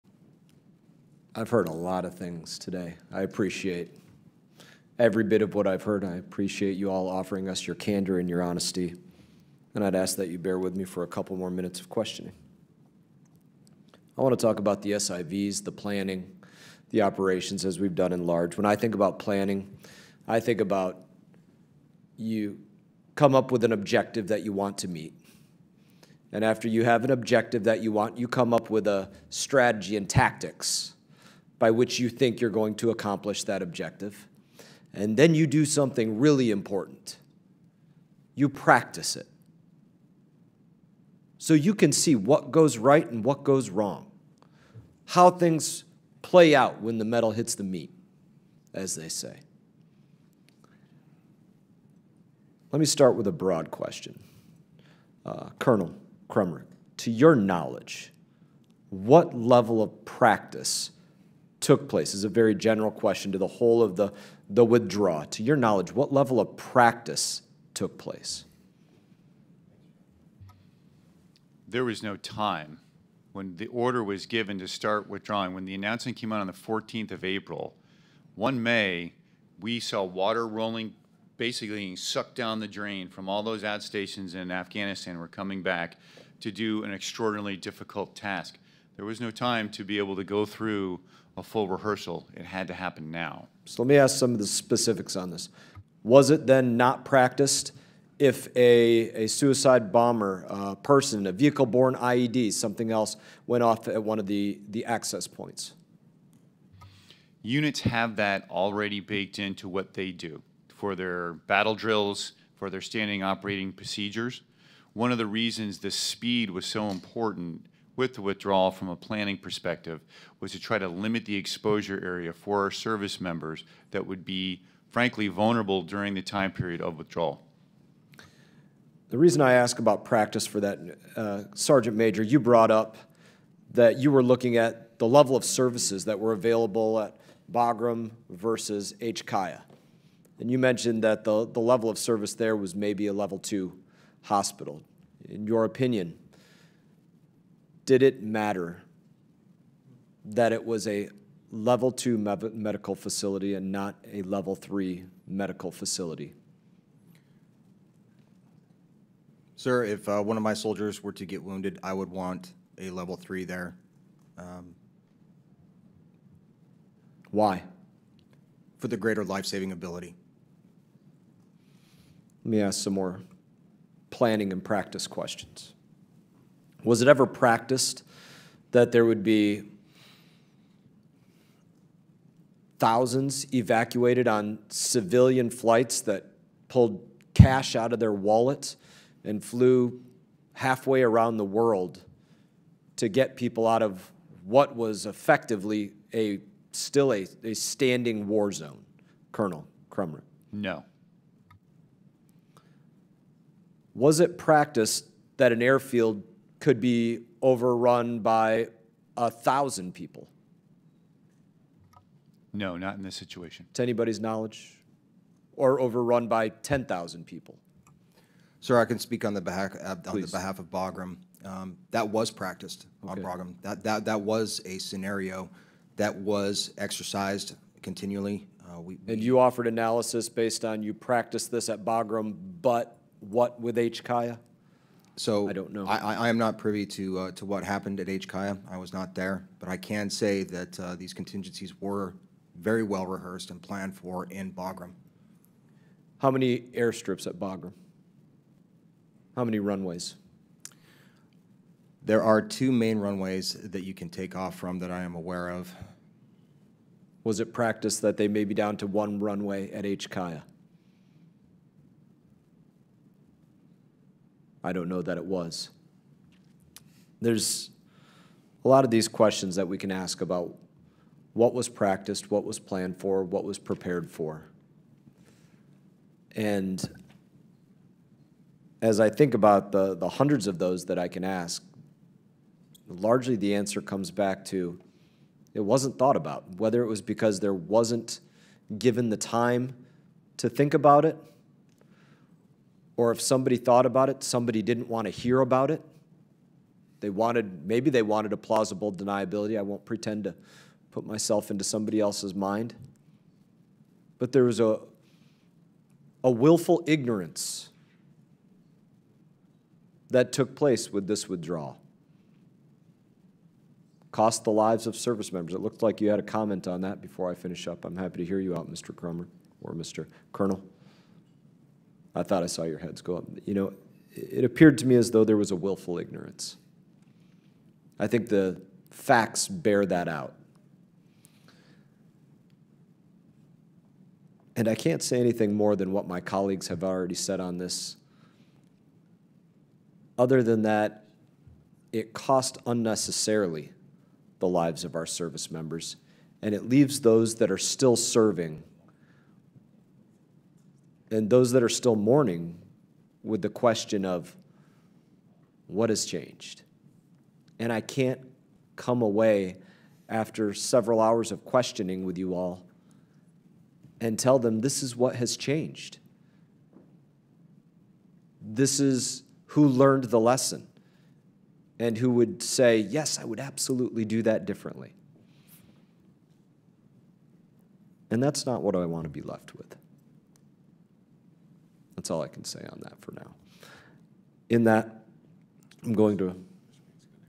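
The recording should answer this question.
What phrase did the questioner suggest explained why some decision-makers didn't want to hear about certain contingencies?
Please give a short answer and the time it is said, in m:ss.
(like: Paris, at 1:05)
plausible deniability, at 4:58.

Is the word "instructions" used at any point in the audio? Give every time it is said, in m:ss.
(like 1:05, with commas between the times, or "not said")
not said.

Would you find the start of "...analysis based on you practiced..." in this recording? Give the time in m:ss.
3:49.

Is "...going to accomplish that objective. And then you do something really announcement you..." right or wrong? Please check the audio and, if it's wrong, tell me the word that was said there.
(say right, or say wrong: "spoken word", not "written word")
wrong: "important", not "announcement".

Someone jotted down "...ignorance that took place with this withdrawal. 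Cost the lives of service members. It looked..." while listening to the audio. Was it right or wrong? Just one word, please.
right.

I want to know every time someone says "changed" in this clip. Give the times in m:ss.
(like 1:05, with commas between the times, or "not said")
5:56, 6:05.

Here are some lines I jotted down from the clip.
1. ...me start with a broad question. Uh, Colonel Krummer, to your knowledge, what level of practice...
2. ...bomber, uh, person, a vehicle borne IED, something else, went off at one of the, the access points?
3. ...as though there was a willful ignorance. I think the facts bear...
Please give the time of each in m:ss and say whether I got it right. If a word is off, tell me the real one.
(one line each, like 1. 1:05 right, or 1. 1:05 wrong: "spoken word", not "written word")
1. 0:52 right
2. 1:39 right
3. 5:24 right.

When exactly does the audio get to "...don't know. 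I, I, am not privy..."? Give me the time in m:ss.
3:55.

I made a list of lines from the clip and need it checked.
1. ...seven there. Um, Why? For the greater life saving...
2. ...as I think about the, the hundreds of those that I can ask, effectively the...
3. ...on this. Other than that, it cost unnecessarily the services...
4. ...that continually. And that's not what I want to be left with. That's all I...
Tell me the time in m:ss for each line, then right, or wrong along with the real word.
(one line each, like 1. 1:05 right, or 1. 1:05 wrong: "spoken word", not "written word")
1. 2:43 wrong: "three", not "seven"
2. 4:38 wrong: "largely", not "effectively"
3. 5:37 wrong: "lives", not "services"
4. 6:14 wrong: "differently", not "continually".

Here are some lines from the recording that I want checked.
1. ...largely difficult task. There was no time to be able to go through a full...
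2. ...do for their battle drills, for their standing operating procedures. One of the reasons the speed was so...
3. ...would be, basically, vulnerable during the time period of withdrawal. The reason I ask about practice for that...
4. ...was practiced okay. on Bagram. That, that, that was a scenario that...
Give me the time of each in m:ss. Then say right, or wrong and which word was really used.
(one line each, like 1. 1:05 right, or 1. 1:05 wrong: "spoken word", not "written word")
1. 1:26 wrong: "extraordinarily", not "largely"
2. 1:50 right
3. 2:04 wrong: "frankly", not "basically"
4. 3:42 right.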